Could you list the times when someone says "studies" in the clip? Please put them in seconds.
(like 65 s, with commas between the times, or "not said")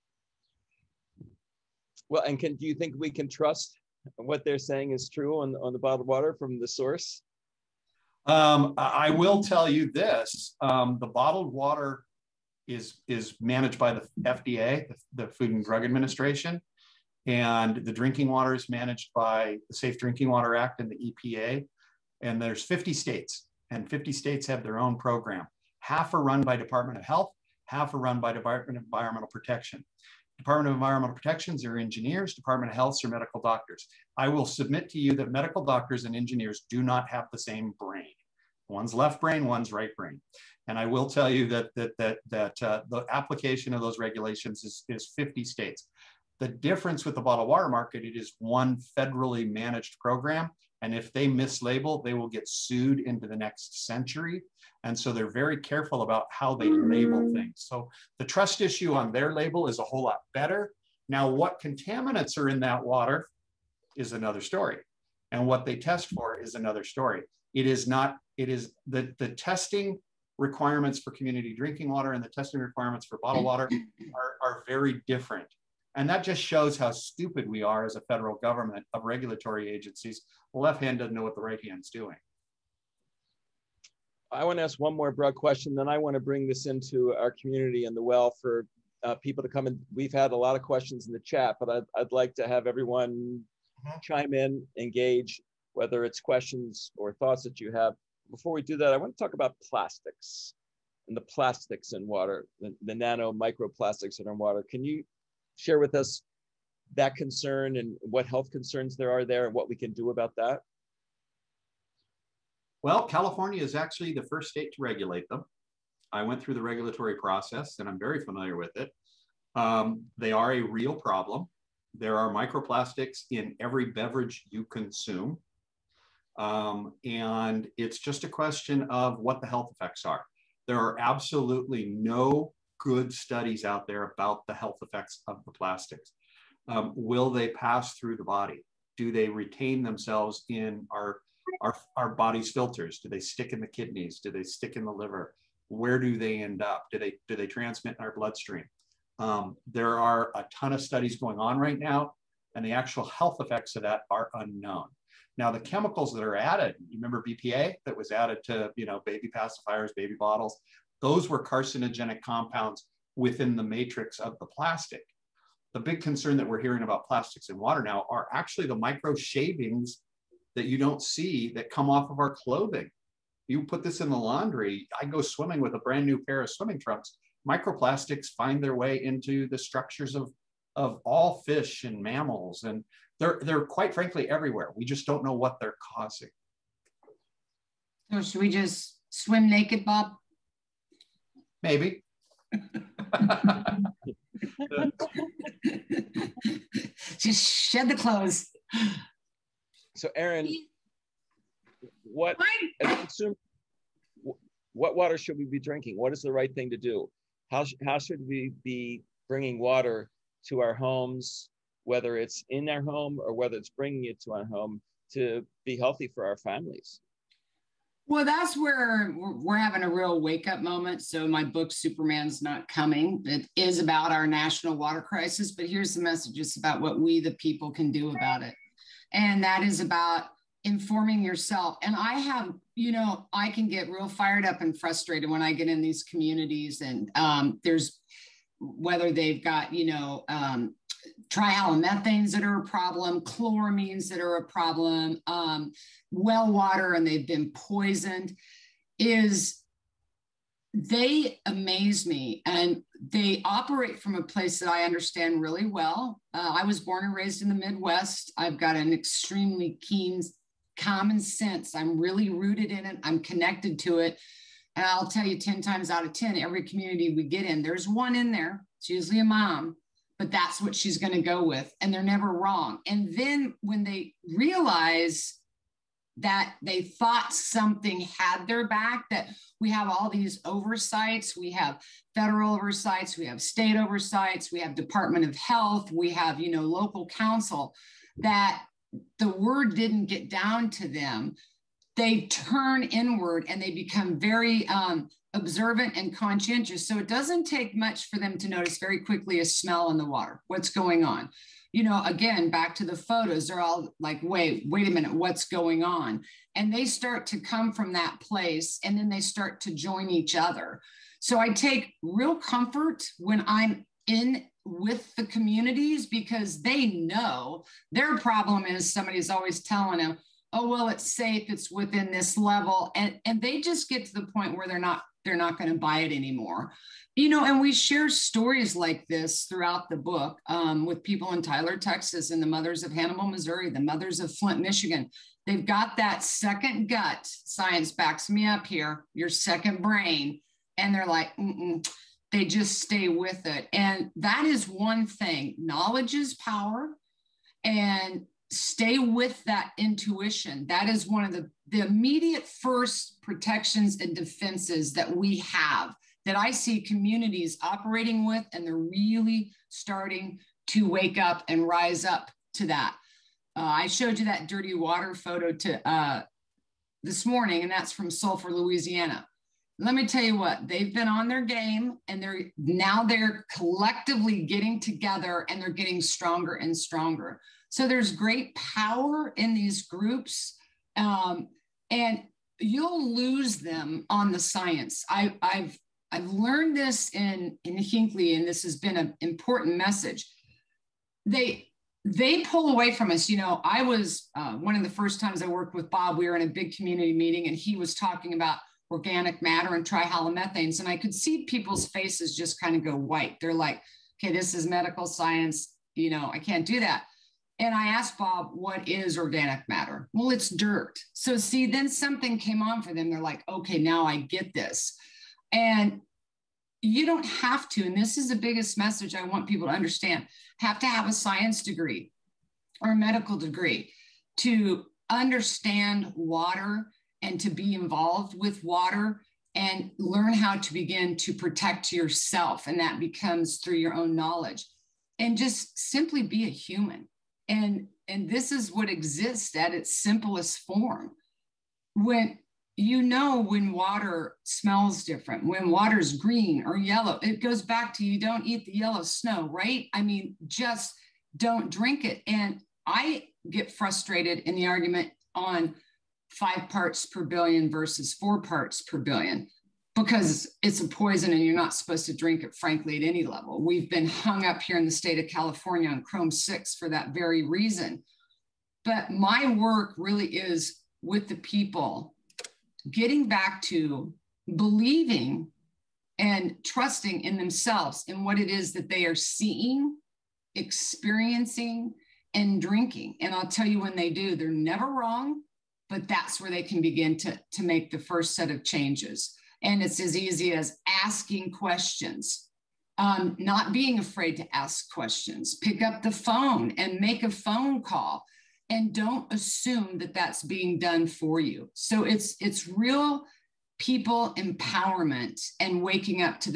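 133 s, 150 s.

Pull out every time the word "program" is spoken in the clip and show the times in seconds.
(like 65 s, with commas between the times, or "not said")
24 s, 50 s.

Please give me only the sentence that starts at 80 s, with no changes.
The left hand doesn't know what the right hand's doing.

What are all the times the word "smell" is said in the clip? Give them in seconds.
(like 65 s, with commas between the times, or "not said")
299 s, 444 s.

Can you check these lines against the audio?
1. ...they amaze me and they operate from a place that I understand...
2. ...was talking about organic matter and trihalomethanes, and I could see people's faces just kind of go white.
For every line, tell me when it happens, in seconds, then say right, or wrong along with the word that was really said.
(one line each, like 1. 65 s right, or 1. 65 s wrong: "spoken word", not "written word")
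1. 250 s right
2. 397 s right.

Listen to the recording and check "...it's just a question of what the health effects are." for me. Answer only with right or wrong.
right.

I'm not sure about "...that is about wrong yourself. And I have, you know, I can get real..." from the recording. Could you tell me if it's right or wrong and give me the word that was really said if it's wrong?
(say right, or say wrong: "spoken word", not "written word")
wrong: "informing", not "wrong".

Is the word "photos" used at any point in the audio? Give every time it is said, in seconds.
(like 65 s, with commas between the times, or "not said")
302 s, 365 s.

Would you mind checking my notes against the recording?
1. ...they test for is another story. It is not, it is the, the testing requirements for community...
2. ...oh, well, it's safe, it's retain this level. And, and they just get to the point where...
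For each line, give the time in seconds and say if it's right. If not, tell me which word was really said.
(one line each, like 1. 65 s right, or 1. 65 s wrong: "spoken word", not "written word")
1. 65 s right
2. 320 s wrong: "within", not "retain".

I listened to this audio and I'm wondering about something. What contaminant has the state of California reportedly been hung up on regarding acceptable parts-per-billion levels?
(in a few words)
Chrome 6.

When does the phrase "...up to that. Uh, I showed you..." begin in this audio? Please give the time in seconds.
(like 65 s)
362 s.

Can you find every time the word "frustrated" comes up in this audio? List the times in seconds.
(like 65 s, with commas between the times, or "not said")
234 s, 453 s.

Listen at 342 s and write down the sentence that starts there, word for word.
they just stay with it and that is one thing knowledge is power and stay with that intuition.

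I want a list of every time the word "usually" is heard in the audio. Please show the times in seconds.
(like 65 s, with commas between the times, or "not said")
268 s.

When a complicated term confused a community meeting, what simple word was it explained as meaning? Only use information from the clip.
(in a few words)
Dirt.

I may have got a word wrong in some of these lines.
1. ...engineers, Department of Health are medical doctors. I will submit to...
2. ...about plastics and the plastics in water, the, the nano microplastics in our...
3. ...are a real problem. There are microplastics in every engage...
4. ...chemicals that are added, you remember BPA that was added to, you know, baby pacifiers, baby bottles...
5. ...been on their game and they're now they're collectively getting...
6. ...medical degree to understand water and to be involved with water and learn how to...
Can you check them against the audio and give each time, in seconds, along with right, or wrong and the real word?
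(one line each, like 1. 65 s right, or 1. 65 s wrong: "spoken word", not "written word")
1. 31 s right
2. 99 s right
3. 120 s wrong: "beverage", not "engage"
4. 155 s right
5. 370 s right
6. 422 s right.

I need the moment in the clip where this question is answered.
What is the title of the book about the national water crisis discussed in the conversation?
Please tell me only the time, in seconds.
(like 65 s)
221 s.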